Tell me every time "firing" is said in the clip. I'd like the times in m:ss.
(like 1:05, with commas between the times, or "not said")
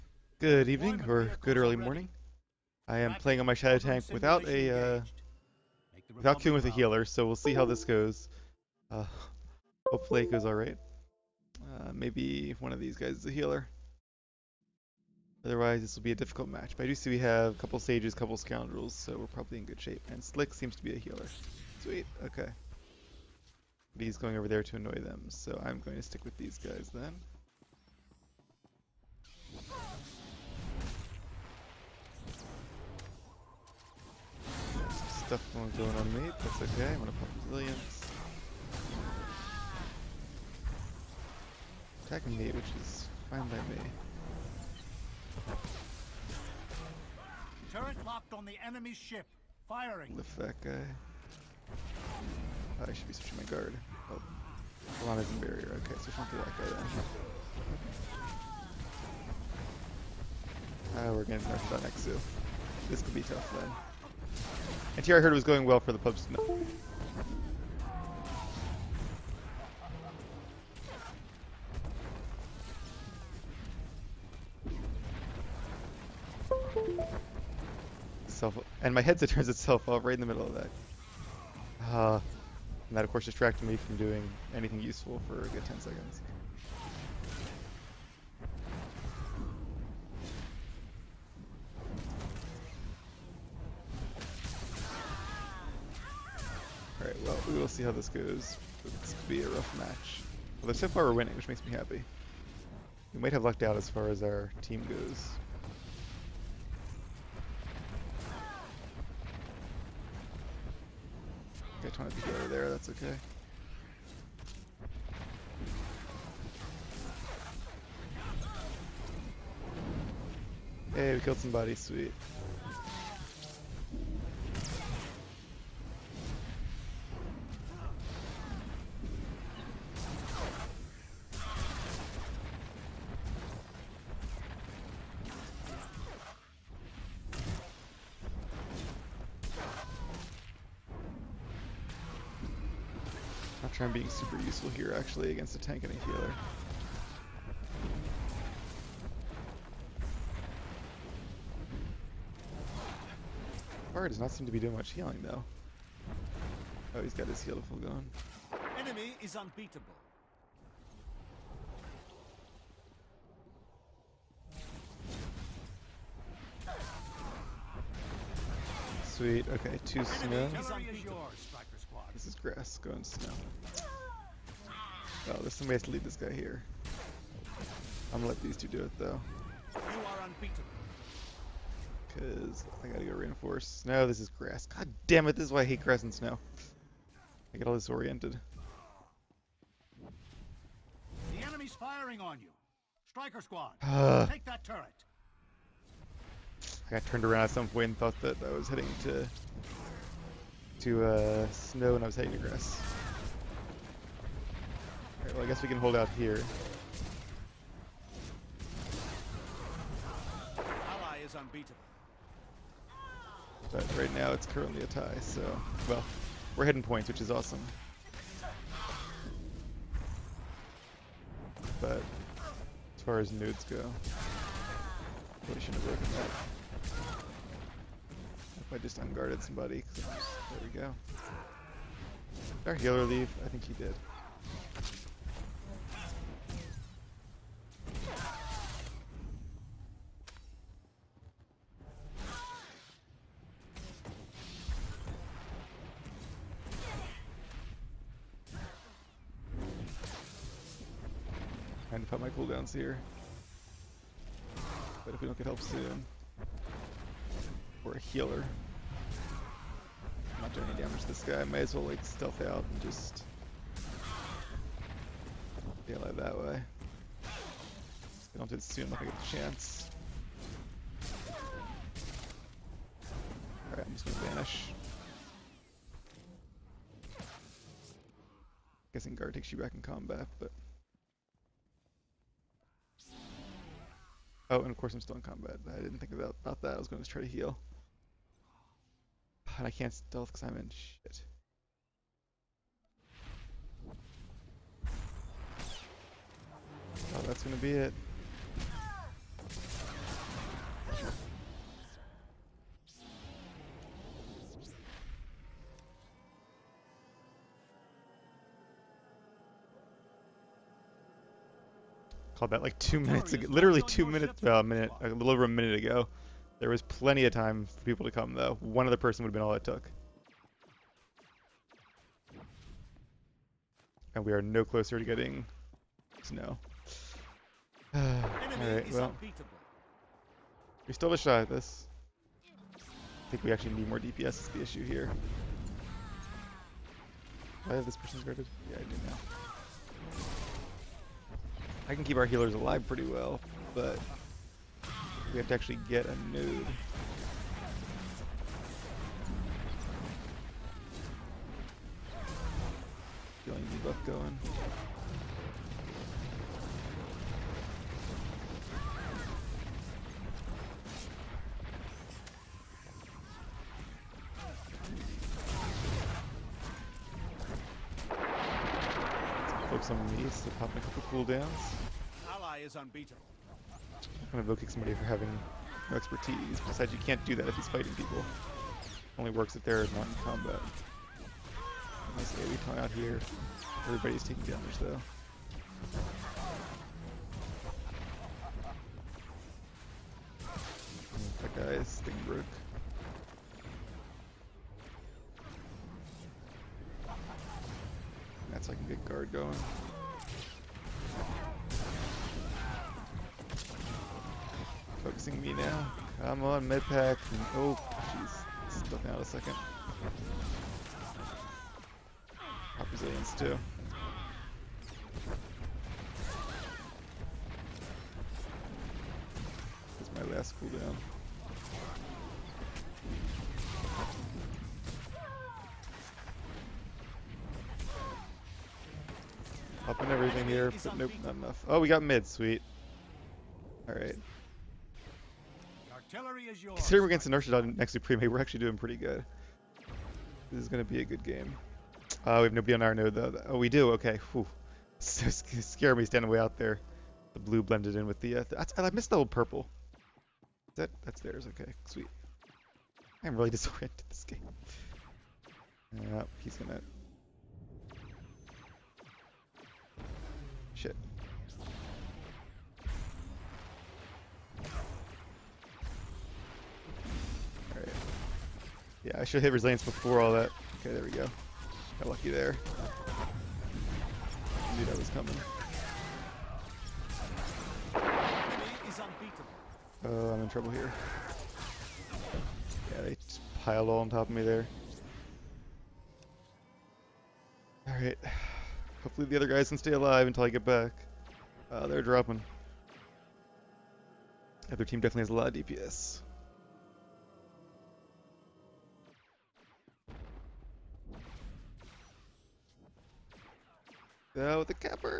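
0:49, 3:11.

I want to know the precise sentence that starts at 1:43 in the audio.
We might have lucked out as far as our team goes.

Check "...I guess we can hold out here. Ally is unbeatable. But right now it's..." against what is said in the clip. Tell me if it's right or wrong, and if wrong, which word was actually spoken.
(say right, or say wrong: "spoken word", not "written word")
right.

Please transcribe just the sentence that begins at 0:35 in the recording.
stuff going on me, that's okay, I'm gonna pop resilience.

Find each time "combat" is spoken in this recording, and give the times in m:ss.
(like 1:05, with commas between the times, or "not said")
4:39, 4:45, 6:20.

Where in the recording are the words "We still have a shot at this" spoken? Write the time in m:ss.
5:30.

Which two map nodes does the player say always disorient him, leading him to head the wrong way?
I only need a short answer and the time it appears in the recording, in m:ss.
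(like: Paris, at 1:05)
grass and snow, at 3:05.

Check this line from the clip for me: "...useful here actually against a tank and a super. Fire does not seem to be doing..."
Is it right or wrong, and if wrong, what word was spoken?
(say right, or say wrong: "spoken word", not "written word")
wrong: "healer", not "super".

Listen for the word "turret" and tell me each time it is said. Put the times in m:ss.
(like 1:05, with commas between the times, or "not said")
0:47, 3:14.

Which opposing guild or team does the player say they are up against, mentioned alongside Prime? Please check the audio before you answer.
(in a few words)
Inertia.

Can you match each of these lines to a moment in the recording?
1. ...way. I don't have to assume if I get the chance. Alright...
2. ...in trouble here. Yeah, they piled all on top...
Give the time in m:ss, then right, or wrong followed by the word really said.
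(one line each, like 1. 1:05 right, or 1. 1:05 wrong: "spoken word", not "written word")
1. 4:26 right
2. 8:00 right.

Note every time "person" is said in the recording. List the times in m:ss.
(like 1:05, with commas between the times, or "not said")
5:18, 5:37.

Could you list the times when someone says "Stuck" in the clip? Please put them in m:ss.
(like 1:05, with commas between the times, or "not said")
6:48.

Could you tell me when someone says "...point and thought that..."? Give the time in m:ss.
3:17.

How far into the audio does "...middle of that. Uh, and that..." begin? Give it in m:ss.
1:20.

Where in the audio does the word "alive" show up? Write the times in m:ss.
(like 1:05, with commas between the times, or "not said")
5:42, 8:09.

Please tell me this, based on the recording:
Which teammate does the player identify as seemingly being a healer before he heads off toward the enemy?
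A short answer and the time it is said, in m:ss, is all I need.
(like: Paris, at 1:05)
Slick, at 0:20.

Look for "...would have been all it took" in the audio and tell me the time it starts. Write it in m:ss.
5:19.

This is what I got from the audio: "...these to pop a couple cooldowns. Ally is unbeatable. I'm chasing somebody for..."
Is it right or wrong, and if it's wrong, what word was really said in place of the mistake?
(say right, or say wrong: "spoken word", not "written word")
wrong: "invoking", not "chasing".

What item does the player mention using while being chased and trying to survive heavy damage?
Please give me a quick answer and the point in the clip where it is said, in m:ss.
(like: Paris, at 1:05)
medpack, at 6:46.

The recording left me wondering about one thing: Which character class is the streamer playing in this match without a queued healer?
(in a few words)
Shadow Tank.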